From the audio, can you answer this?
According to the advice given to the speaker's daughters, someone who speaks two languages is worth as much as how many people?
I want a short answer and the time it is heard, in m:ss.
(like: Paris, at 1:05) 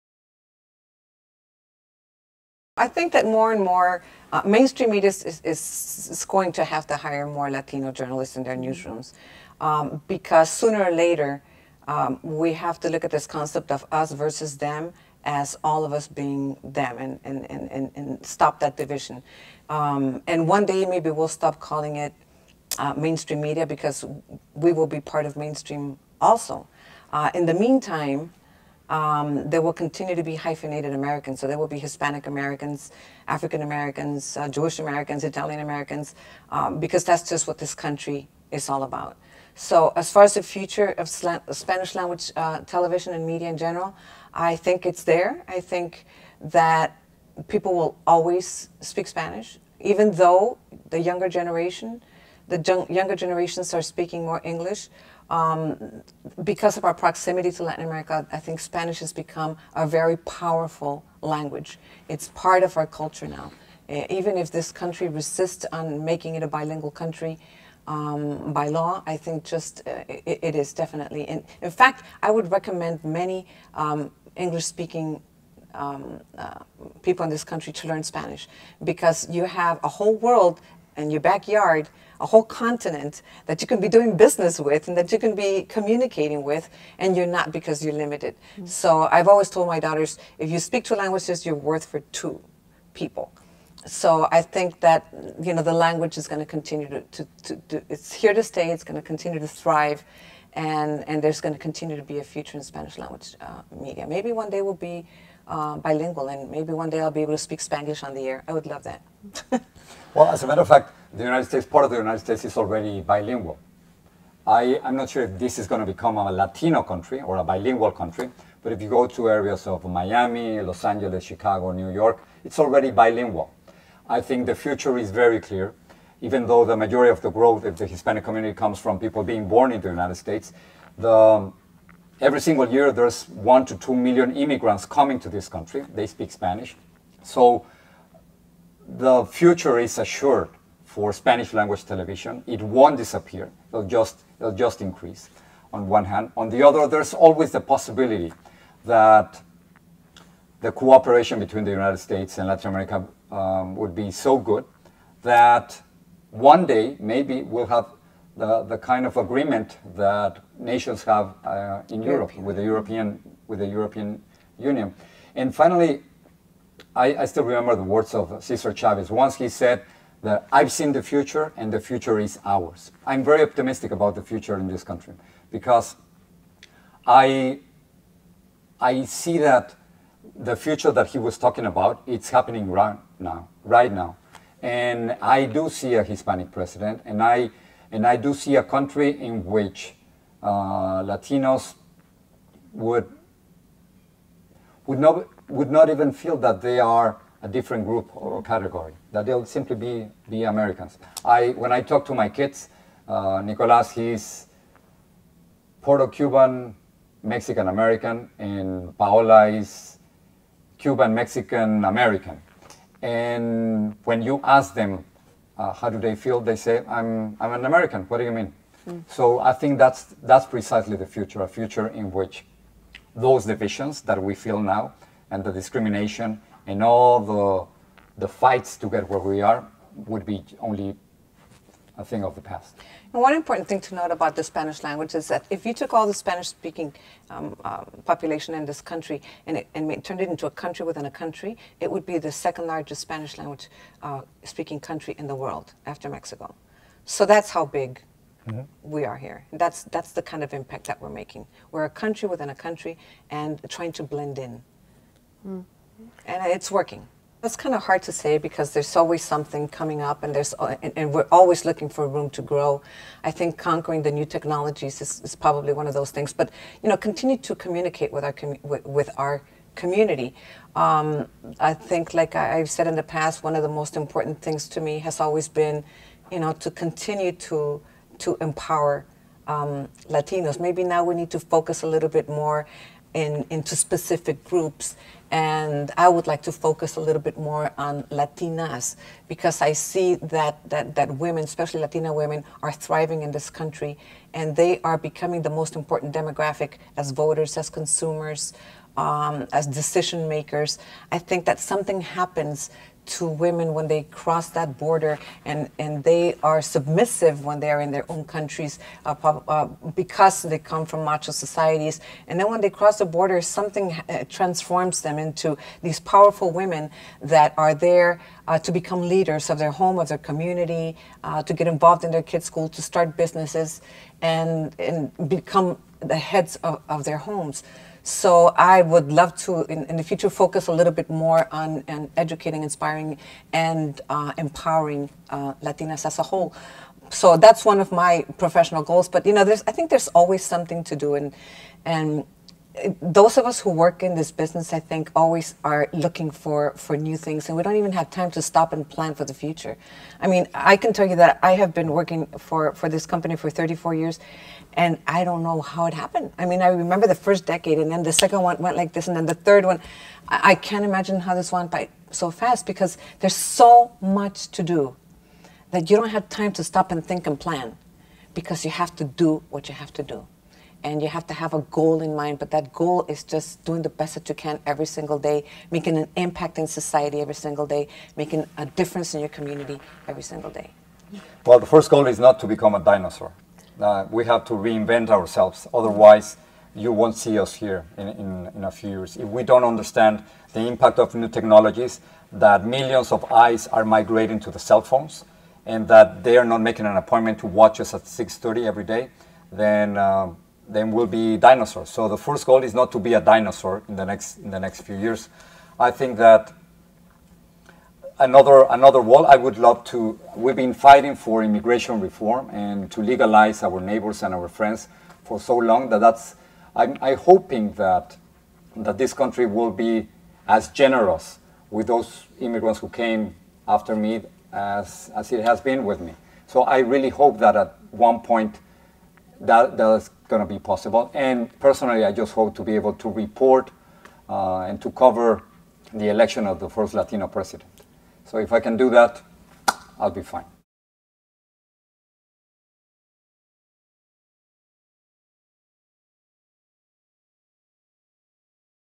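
2, at 1:32.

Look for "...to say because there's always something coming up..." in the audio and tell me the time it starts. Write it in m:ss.
4:18.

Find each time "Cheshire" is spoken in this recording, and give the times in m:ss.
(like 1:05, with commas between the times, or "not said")
not said.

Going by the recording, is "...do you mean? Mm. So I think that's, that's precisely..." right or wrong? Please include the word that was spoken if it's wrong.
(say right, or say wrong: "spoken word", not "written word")
right.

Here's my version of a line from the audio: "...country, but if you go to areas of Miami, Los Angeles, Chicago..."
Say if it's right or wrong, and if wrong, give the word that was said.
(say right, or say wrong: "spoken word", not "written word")
right.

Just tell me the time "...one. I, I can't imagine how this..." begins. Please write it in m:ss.
5:59.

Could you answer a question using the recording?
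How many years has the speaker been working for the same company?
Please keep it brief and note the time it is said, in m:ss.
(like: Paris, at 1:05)
34, at 5:53.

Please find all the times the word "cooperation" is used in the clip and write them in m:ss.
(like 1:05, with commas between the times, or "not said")
2:30.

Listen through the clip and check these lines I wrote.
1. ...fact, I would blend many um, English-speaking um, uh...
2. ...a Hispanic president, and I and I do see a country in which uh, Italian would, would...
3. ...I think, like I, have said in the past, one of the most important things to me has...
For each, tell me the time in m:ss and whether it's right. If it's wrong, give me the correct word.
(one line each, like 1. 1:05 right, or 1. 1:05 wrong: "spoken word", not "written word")
1. 1:11 wrong: "recommend", not "blend"
2. 3:05 wrong: "Latinos", not "Italian"
3. 4:31 right.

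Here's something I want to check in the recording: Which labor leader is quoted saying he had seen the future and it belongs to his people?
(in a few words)
Cesar Chavez.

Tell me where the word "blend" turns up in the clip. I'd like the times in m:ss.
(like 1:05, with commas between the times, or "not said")
4:14.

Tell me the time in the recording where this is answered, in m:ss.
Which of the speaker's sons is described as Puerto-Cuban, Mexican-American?
3:23.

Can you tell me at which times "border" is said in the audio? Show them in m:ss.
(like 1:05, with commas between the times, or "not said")
5:04, 5:13.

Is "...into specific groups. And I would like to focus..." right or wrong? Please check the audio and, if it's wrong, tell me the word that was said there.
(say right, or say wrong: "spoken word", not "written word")
right.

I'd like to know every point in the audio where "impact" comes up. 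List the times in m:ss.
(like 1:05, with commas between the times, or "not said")
4:10, 6:16, 6:30.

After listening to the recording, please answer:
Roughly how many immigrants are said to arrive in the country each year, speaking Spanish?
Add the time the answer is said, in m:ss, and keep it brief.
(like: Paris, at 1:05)
1 to 2 million, at 2:13.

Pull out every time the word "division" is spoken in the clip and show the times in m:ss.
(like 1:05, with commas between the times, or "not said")
0:18, 3:43.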